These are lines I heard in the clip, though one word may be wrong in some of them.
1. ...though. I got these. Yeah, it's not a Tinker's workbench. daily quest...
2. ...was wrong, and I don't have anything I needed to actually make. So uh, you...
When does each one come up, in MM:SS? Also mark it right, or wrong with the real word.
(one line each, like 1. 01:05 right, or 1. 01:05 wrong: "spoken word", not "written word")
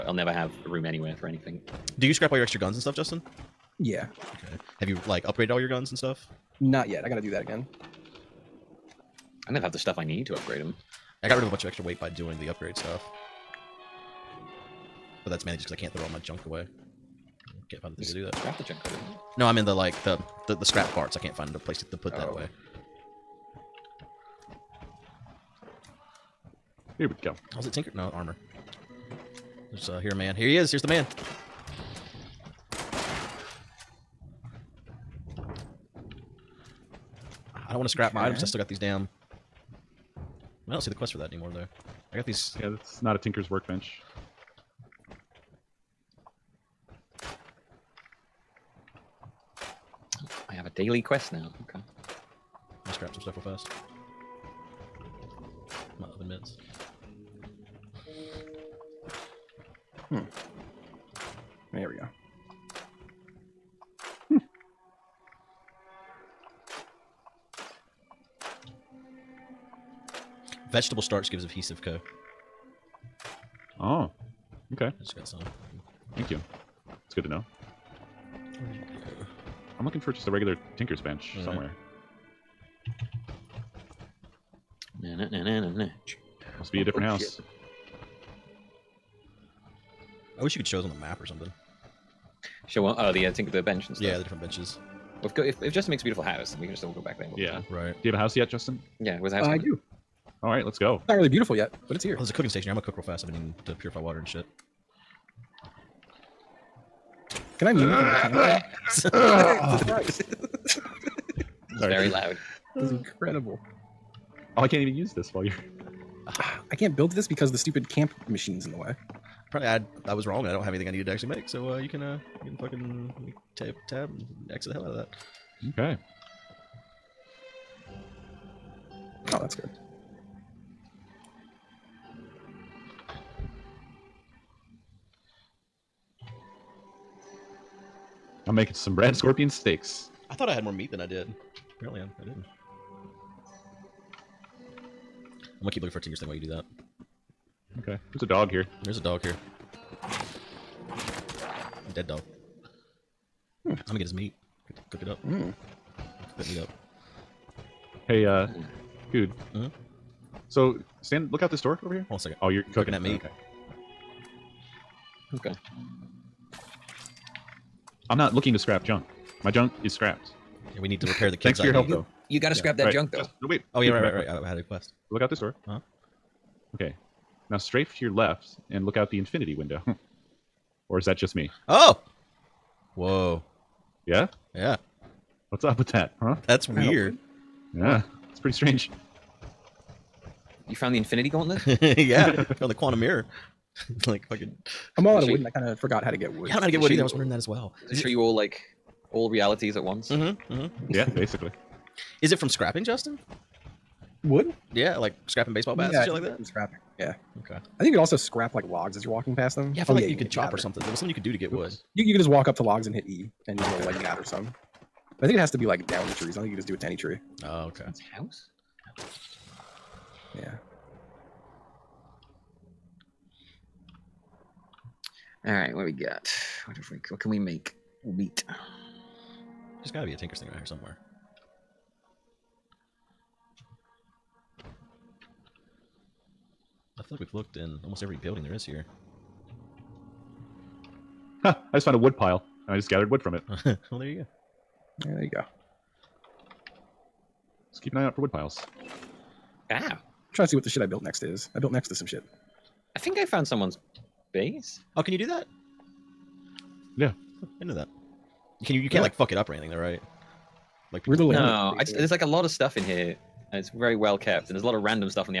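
1. 00:41 right
2. 02:00 right.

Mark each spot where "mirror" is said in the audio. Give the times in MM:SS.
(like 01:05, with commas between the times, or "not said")
03:12.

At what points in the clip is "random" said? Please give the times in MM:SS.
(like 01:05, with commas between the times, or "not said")
04:24.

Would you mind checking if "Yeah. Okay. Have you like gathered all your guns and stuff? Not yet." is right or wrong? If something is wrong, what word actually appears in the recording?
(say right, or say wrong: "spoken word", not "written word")
wrong: "upgraded", not "gathered".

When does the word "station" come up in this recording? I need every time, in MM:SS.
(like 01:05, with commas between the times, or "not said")
01:42.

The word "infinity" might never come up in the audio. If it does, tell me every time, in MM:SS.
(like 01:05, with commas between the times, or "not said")
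02:59, 03:10.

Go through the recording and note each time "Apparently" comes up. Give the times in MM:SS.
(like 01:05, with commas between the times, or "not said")
01:59, 02:21.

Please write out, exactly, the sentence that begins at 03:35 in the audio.
I think it has to be like down the trees.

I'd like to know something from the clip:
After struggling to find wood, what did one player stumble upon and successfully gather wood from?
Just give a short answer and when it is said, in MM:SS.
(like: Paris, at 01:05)
A wood pile, at 04:01.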